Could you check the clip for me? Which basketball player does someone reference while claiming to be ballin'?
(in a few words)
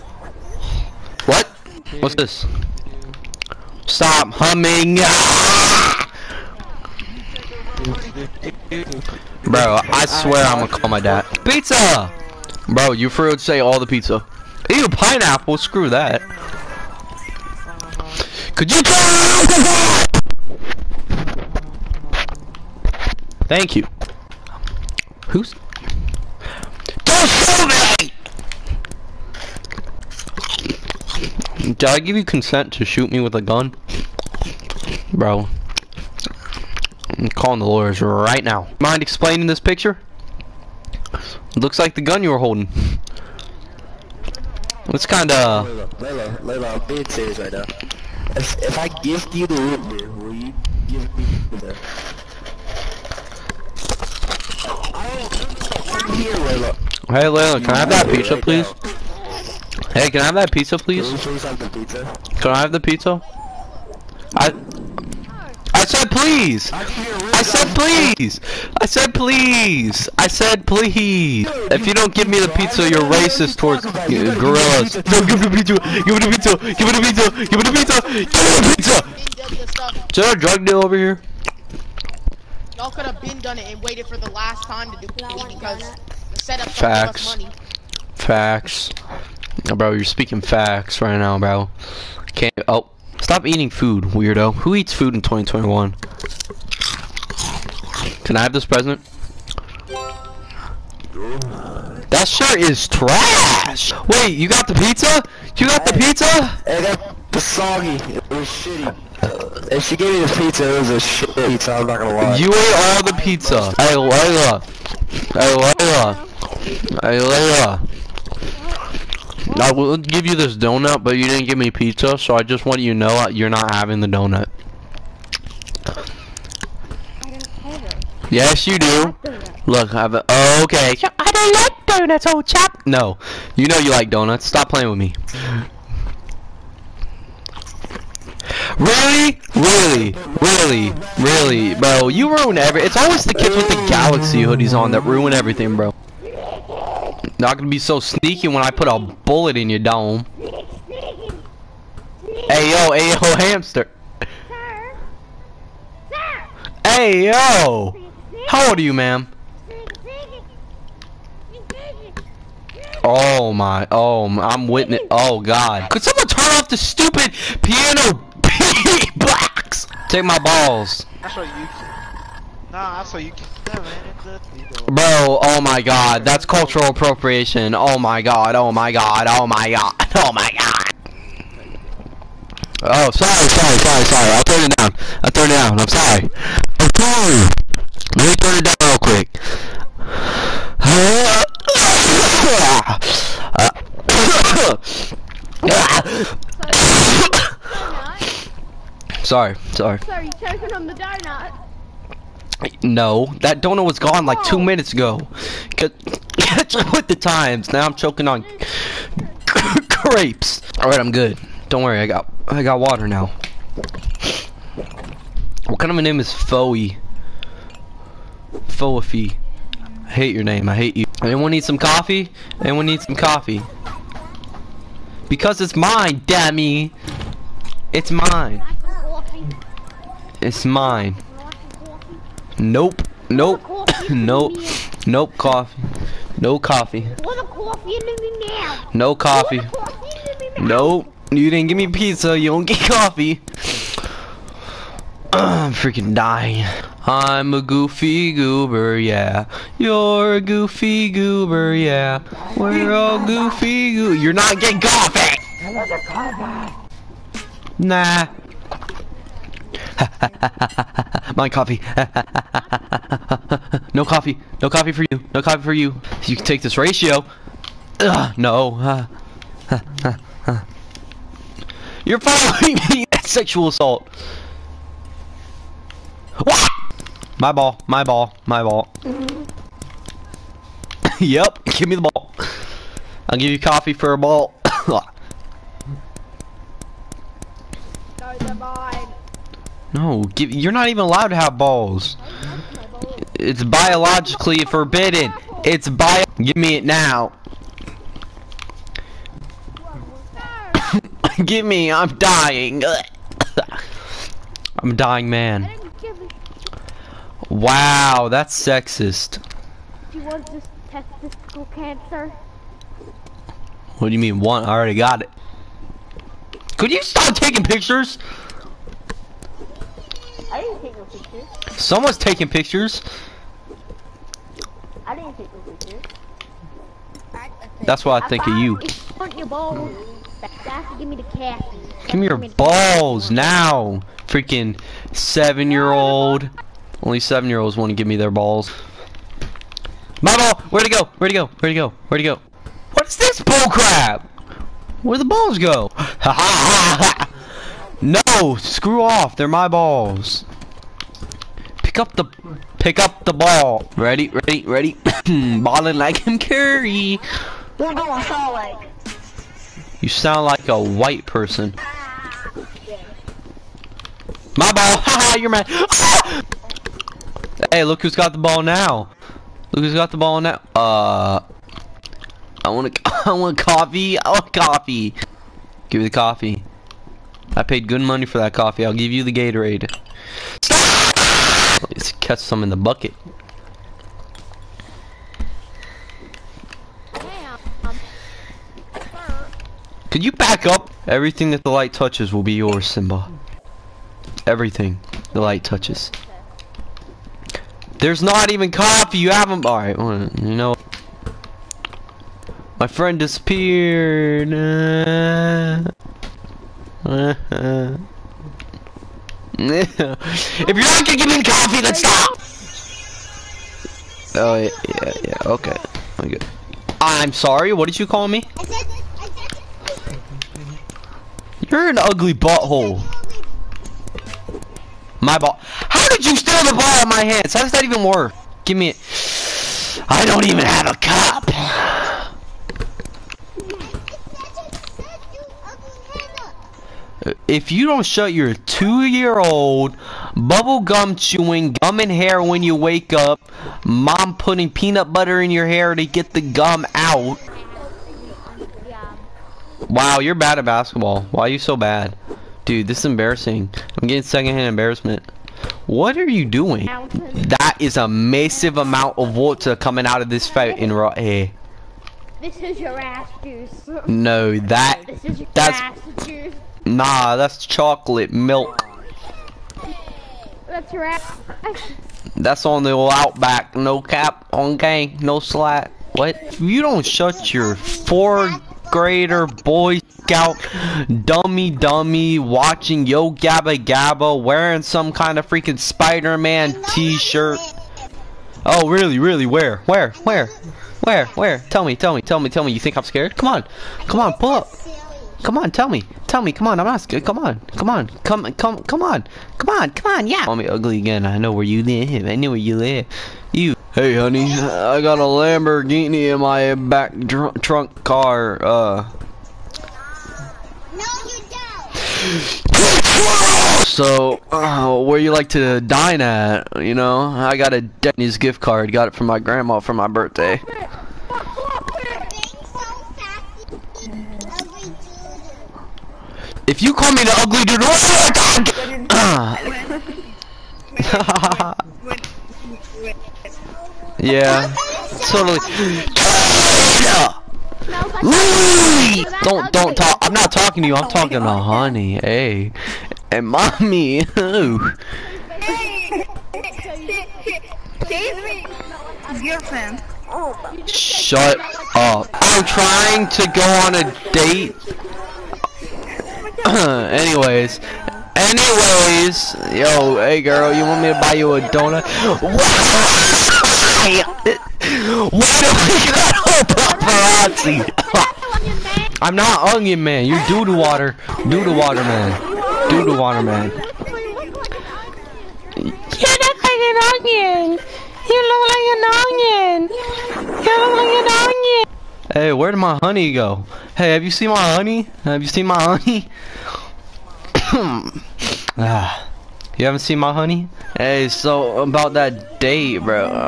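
Curry.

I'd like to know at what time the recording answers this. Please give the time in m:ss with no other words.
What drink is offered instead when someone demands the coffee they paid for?
6:19.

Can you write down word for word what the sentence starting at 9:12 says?
I'm trying to go on a date.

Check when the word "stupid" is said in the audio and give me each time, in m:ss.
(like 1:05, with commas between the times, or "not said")
2:46.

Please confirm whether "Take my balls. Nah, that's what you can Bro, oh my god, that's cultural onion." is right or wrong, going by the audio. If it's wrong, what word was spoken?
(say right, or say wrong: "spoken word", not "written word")
wrong: "appropriation", not "onion".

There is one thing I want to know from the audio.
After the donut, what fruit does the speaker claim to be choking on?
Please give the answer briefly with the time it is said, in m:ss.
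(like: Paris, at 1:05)
Grapes, at 3:29.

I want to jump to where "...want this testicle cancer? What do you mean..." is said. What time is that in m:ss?
5:10.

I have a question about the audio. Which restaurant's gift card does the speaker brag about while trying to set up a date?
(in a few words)
Denny's.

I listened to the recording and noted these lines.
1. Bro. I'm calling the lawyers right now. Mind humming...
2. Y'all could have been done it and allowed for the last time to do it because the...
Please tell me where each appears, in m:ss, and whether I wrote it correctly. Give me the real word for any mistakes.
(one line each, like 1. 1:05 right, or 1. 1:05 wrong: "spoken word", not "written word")
1. 0:35 wrong: "explaining", not "humming"
2. 1:22 wrong: "waited", not "allowed".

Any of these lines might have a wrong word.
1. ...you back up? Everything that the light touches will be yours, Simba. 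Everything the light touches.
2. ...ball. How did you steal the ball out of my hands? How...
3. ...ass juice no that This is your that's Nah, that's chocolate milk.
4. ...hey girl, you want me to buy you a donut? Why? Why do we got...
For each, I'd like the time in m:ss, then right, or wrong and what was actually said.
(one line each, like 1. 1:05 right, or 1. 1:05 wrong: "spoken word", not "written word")
1. 6:30 right
2. 7:05 right
3. 7:42 right
4. 9:20 right.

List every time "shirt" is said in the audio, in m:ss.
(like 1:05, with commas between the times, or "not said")
1:42, 8:06.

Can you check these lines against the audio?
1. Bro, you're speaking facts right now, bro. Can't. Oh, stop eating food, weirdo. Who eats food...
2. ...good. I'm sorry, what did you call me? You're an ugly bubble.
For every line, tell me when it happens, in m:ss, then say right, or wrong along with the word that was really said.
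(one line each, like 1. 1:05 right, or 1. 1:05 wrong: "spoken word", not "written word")
1. 1:29 right
2. 6:56 wrong: "butthole", not "bubble".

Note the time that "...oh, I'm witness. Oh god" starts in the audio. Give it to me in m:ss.
2:43.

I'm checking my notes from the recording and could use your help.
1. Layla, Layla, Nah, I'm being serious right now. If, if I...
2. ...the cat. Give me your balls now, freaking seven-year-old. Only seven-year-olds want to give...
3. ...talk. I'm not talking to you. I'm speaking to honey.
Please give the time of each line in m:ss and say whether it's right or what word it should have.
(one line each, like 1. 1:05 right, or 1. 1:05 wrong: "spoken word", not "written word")
1. 0:45 wrong: "Layla", not "Nah"
2. 5:31 right
3. 8:59 wrong: "talking", not "speaking".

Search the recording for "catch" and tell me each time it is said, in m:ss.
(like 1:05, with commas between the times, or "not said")
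3:25, 6:22.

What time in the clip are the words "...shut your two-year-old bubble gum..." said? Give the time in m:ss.
7:18.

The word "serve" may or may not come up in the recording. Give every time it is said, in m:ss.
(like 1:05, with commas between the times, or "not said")
not said.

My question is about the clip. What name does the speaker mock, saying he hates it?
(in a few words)
Foey.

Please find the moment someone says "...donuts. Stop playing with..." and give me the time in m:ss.
2:14.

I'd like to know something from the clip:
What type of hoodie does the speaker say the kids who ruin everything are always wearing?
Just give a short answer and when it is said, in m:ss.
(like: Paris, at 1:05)
Galaxy hoodies, at 2:23.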